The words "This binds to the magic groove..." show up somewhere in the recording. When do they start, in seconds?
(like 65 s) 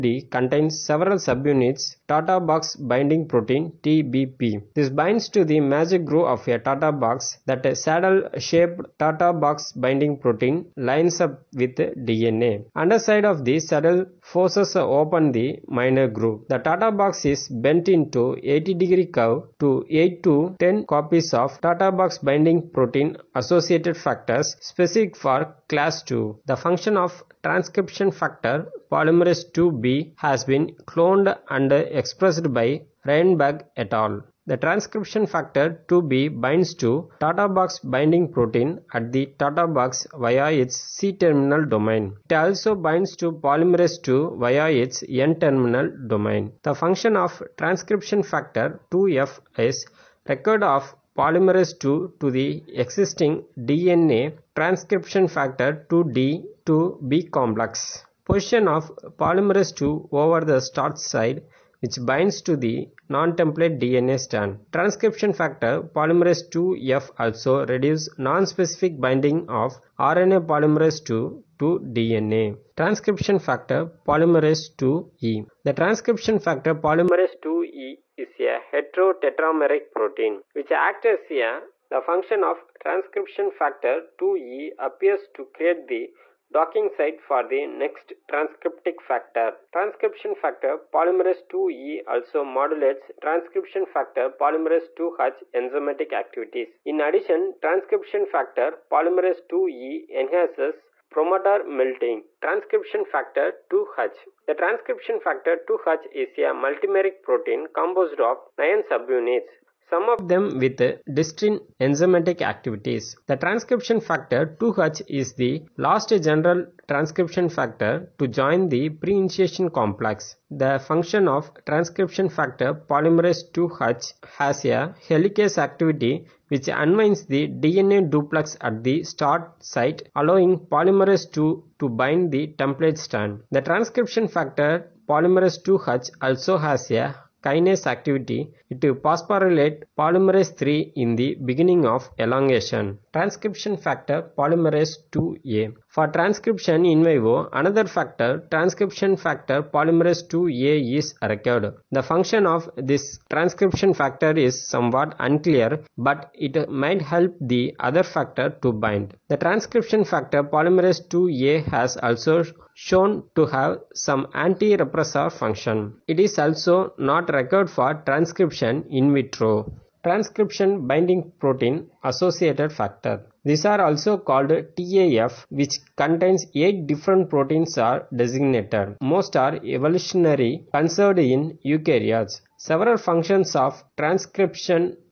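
4 s.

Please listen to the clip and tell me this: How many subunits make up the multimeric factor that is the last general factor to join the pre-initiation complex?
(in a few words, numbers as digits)
9.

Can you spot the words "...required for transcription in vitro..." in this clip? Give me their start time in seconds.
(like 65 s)
167 s.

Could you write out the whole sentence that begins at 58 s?
Position of polymerase II over the start side which binds to the non-template DNA strand.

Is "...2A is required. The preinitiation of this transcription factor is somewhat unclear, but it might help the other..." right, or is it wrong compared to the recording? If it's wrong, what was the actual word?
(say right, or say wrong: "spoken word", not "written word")
wrong: "function", not "preinitiation".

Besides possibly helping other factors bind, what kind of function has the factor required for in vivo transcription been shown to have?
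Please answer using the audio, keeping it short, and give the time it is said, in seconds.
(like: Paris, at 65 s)
Anti-repressor function, at 164 s.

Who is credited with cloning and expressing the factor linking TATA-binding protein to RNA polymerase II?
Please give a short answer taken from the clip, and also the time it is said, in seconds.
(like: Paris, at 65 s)
Reinberg et al., at 33 s.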